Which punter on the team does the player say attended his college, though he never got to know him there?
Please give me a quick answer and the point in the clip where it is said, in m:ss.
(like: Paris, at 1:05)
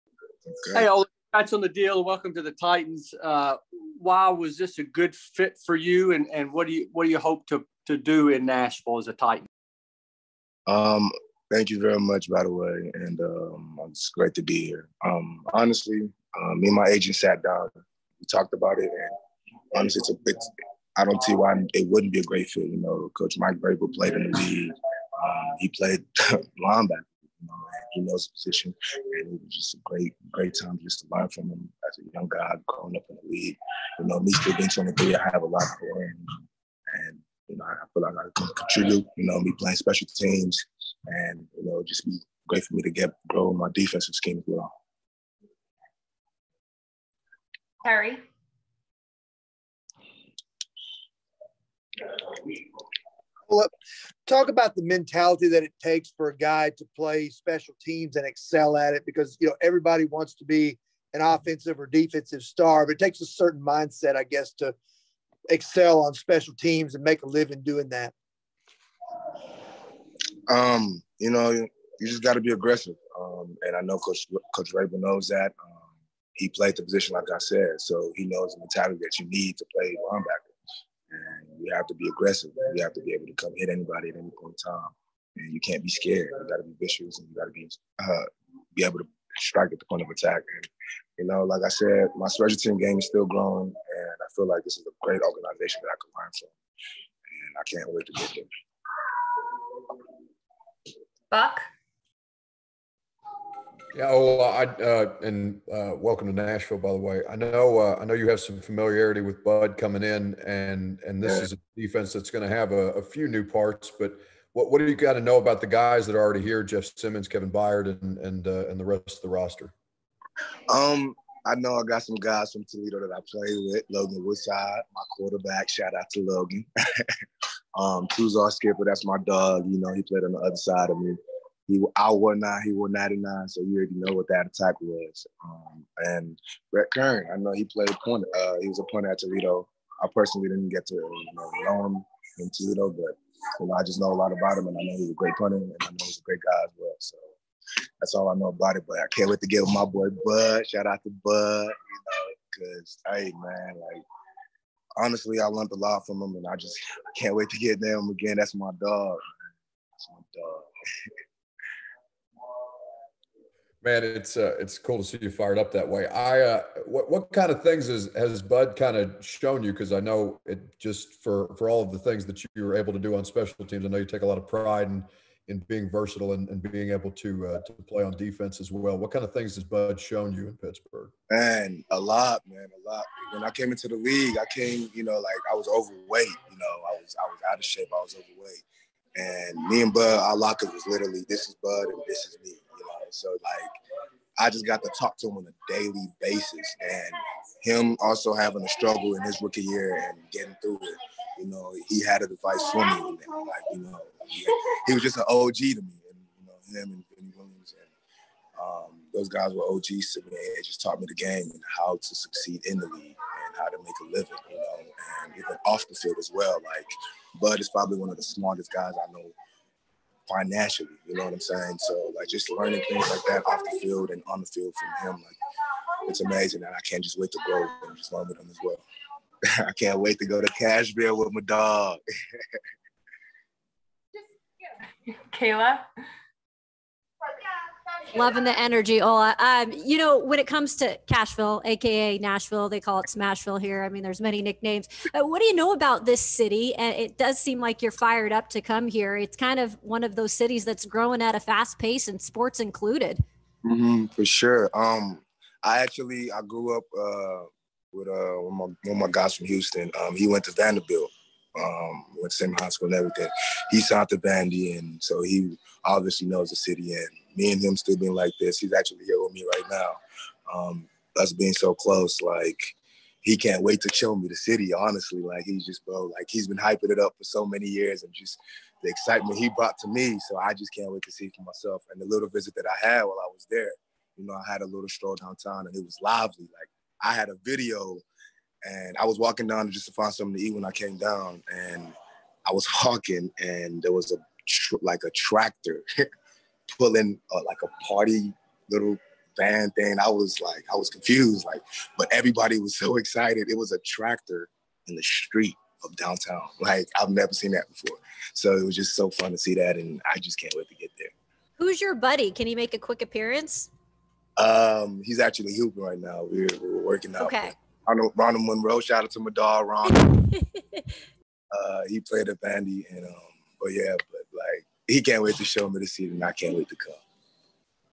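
Brett Kern, at 2:16.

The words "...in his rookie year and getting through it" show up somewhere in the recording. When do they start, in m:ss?
3:19.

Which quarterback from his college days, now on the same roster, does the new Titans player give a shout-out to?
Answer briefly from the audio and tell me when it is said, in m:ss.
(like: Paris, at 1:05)
Logan Woodside, at 2:03.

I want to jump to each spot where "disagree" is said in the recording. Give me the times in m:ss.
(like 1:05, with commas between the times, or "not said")
not said.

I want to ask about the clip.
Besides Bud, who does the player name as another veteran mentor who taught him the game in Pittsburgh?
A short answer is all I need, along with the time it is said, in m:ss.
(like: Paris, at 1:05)
Vinny Williams, at 3:27.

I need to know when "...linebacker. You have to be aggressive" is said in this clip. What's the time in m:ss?
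1:20.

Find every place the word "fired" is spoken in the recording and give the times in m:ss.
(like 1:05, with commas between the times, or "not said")
2:45, 4:07.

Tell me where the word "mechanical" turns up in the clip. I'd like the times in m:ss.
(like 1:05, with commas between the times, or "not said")
not said.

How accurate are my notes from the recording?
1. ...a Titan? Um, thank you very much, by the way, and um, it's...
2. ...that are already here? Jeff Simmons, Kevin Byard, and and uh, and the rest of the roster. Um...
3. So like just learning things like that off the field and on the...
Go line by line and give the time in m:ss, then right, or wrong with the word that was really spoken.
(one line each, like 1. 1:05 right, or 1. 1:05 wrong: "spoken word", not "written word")
1. 0:09 right
2. 1:56 right
3. 3:41 right.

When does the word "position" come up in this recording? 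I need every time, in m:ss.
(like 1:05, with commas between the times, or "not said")
0:28, 1:16.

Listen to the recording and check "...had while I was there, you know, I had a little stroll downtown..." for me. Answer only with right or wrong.
right.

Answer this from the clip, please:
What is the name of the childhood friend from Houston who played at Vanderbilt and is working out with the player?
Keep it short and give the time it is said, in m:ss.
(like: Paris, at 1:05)
Ronald Monroe, at 5:18.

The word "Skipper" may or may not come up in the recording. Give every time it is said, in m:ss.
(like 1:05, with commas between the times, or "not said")
2:08.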